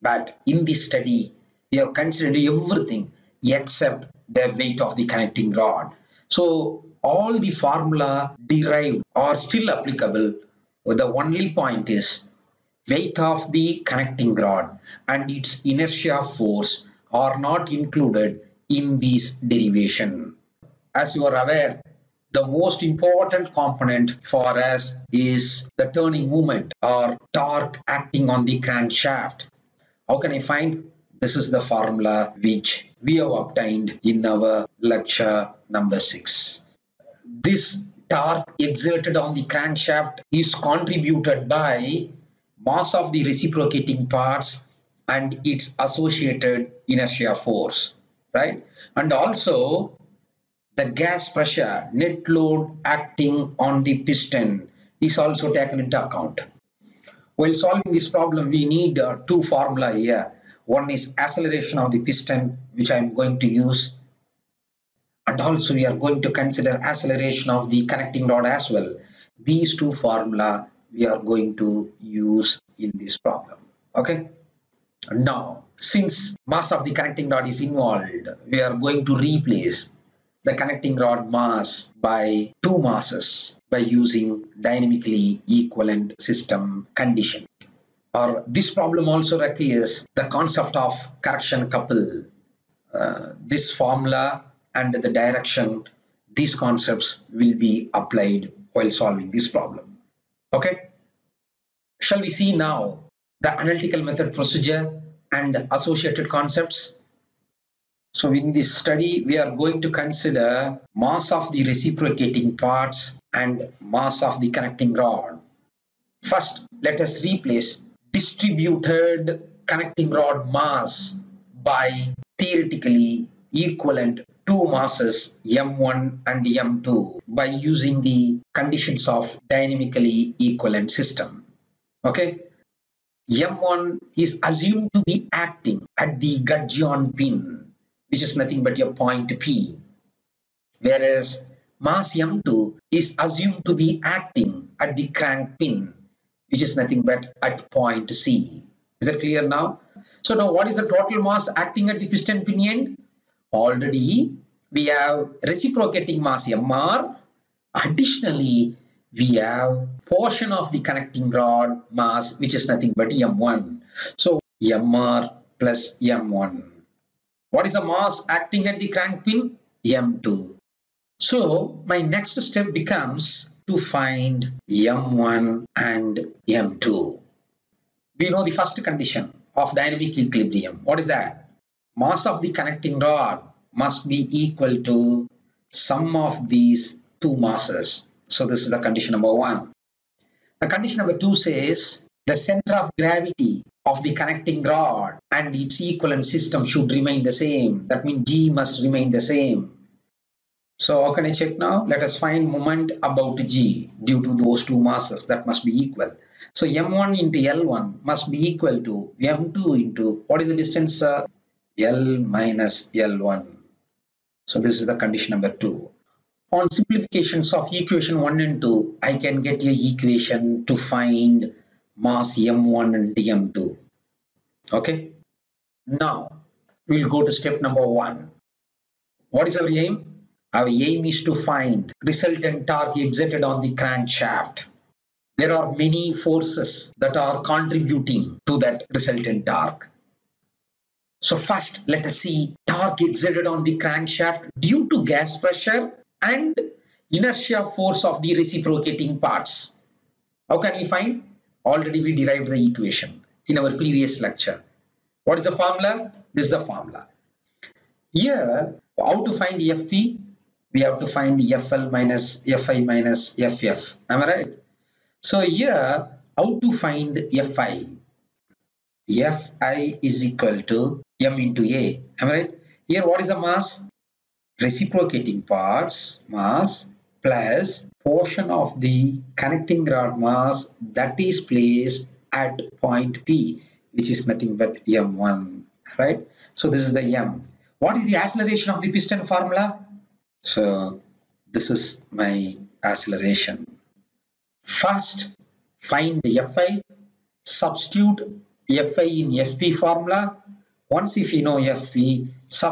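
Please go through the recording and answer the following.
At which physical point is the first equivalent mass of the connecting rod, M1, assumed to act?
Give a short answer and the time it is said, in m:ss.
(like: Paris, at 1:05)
Gudgeon pin, at 2:16.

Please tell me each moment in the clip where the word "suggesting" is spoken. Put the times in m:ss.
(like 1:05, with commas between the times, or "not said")
not said.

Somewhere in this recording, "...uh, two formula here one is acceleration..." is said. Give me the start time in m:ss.
0:58.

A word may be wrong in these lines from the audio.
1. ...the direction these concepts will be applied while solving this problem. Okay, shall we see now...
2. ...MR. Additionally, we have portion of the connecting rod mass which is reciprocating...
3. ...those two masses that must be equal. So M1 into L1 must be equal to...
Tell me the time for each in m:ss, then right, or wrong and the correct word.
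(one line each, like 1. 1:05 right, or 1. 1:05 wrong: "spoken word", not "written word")
1. 1:34 right
2. 2:36 wrong: "nothing", not "reciprocating"
3. 3:24 right.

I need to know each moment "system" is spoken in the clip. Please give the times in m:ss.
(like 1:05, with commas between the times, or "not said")
1:26, 2:10, 3:16.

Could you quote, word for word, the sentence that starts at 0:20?
As you are aware, the most important component for us is the turning moment or torque acting on the crankshaft.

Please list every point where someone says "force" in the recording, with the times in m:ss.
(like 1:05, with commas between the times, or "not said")
0:16, 0:47, 3:56, 4:07.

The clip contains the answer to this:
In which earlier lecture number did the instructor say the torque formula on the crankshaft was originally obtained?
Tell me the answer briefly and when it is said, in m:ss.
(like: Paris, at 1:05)
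6, at 0:34.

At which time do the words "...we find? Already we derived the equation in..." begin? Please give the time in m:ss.
4:10.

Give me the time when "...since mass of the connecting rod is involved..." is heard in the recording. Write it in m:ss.
1:15.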